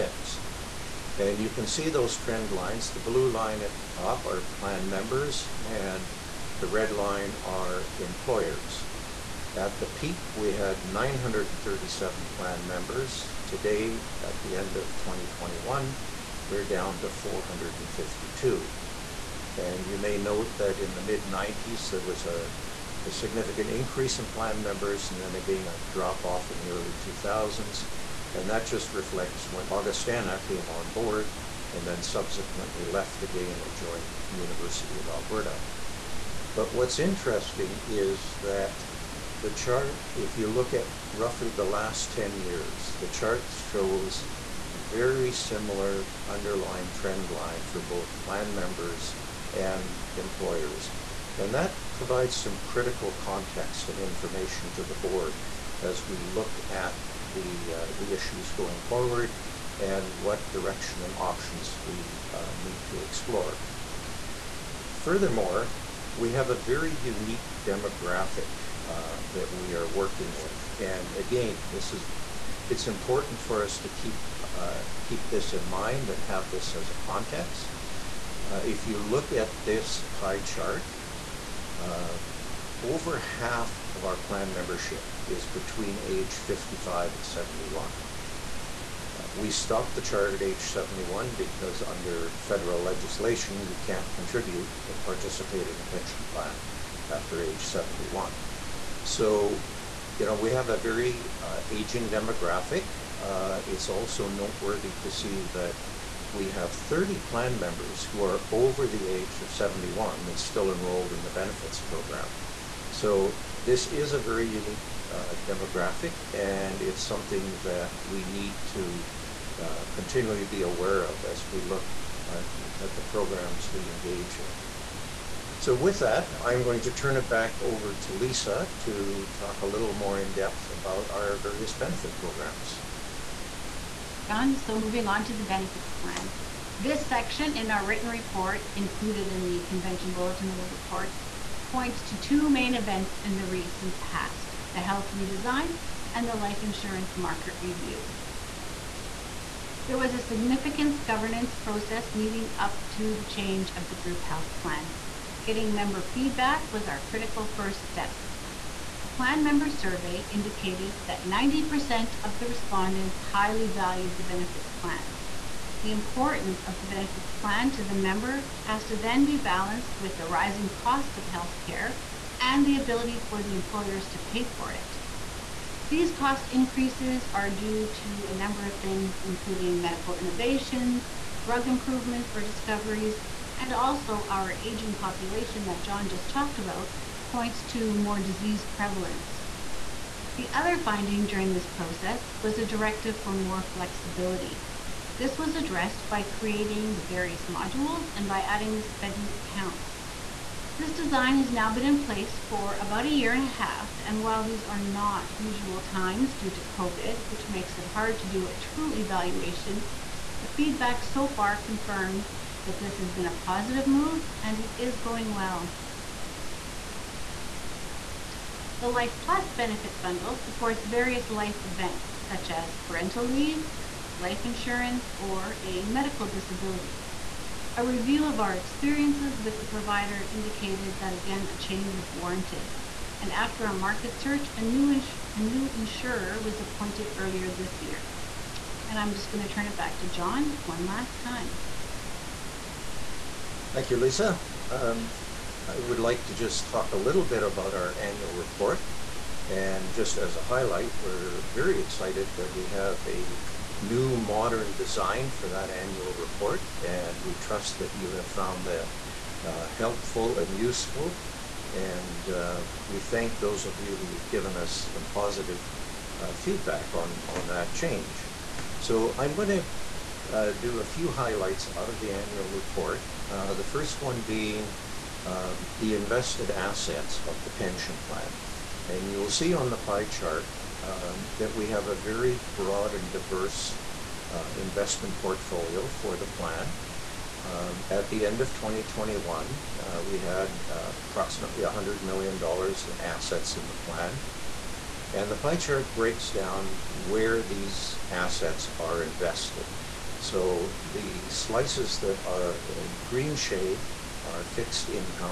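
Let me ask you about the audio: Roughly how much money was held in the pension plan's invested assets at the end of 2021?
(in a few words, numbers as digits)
$100 million.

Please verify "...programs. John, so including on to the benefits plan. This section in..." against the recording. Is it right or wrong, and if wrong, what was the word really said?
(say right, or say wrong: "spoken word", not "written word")
wrong: "moving", not "including".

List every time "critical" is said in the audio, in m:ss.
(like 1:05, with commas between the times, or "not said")
0:52, 2:37.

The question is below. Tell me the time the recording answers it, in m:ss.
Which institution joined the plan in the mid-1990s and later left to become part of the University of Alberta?
0:29.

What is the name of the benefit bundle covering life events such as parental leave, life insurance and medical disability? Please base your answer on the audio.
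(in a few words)
Life Plus.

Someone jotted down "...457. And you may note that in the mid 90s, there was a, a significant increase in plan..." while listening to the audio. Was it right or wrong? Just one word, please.
wrong.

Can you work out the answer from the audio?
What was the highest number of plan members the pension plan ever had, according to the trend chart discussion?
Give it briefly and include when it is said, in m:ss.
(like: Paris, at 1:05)
937, at 0:10.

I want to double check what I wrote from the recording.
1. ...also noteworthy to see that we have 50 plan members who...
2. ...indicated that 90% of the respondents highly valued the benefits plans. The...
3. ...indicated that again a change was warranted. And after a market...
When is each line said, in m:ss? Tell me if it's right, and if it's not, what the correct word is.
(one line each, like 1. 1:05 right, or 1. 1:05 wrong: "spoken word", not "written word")
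1. 1:43 wrong: "30", not "50"
2. 2:40 right
3. 3:50 right.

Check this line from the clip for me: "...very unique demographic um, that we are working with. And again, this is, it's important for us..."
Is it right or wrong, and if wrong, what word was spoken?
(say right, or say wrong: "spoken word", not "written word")
right.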